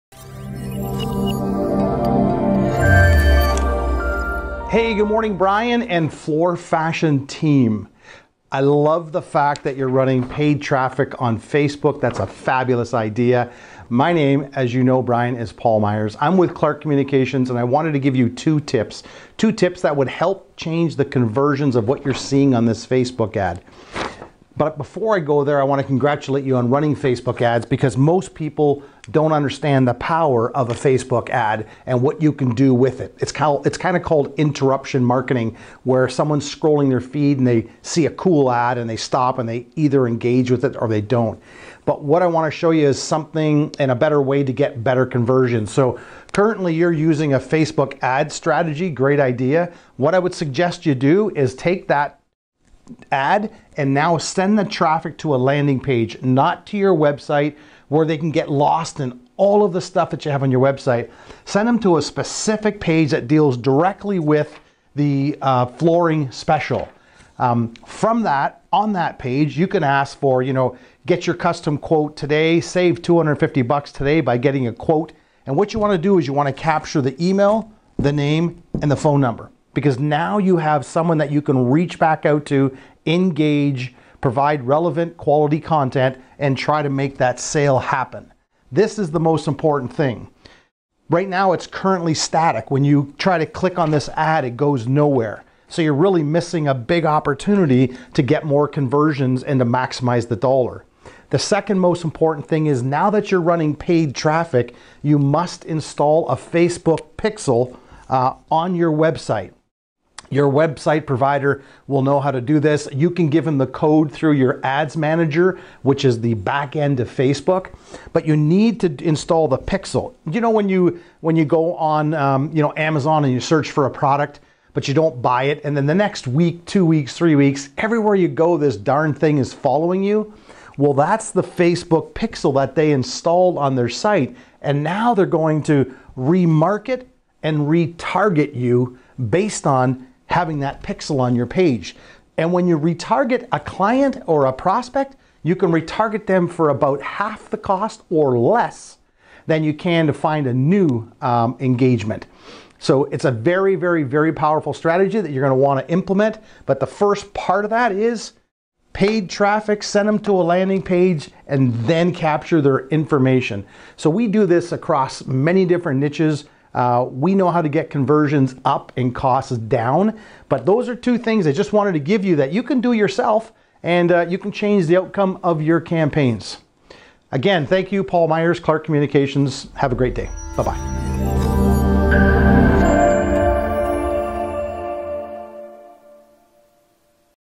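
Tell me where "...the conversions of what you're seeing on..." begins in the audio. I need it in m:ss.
0:20.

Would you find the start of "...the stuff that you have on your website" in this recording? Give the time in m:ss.
0:59.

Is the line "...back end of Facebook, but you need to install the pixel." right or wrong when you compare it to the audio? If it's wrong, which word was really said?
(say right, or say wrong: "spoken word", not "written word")
right.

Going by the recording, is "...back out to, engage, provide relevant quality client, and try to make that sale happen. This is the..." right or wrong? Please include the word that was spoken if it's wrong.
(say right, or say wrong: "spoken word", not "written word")
wrong: "content", not "client".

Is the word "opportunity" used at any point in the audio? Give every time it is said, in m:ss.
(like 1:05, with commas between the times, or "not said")
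1:37.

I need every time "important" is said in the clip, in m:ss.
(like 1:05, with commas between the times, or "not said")
1:29, 1:42.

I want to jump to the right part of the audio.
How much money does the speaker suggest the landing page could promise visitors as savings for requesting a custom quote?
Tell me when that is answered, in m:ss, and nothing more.
1:13.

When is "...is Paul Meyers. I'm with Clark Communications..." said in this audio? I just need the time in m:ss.
0:15.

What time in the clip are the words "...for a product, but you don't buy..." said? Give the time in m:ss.
2:03.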